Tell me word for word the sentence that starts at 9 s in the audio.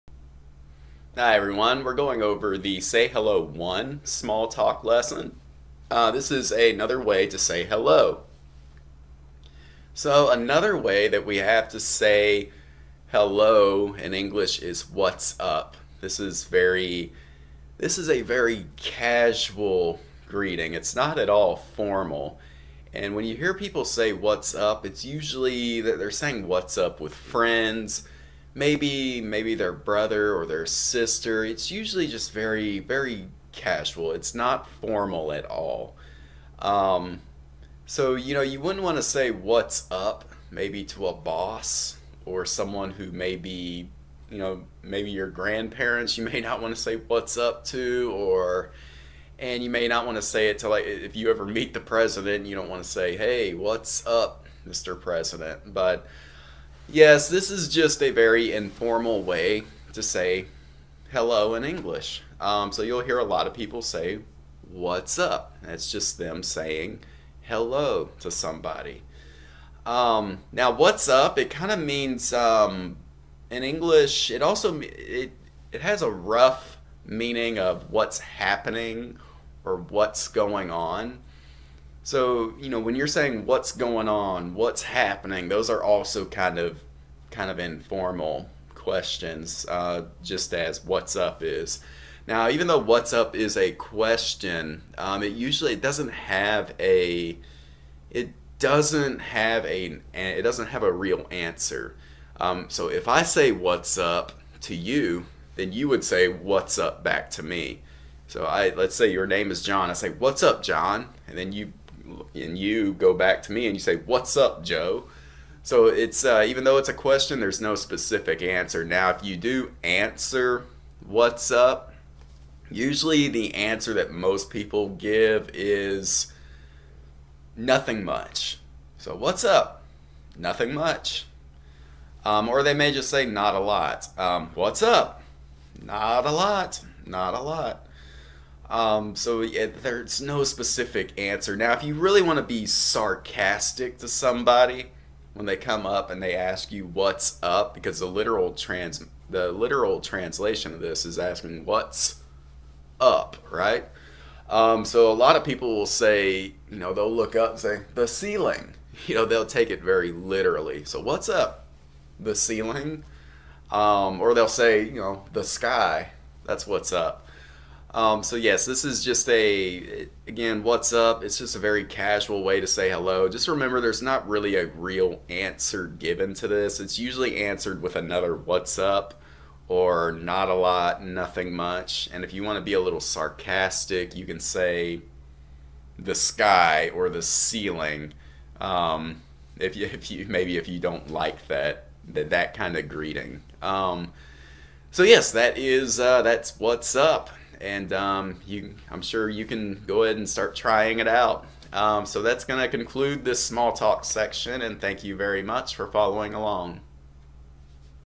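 So another way that we have to say hello in English is what's up.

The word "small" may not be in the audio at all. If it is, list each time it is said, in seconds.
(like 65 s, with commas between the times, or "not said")
4 s, 203 s.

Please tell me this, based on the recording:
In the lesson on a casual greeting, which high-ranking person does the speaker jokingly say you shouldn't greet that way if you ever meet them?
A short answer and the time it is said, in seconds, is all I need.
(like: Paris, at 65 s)
the president, at 51 s.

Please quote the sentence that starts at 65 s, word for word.
That's just them saying hello to somebody.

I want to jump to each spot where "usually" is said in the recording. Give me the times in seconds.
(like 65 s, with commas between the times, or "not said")
25 s, 31 s, 95 s, 122 s, 176 s.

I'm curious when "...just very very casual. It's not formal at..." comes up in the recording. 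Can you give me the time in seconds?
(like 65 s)
32 s.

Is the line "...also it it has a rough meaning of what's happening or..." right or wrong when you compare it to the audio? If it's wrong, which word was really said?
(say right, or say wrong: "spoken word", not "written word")
right.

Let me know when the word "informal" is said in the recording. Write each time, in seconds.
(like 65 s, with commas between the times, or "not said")
58 s, 87 s.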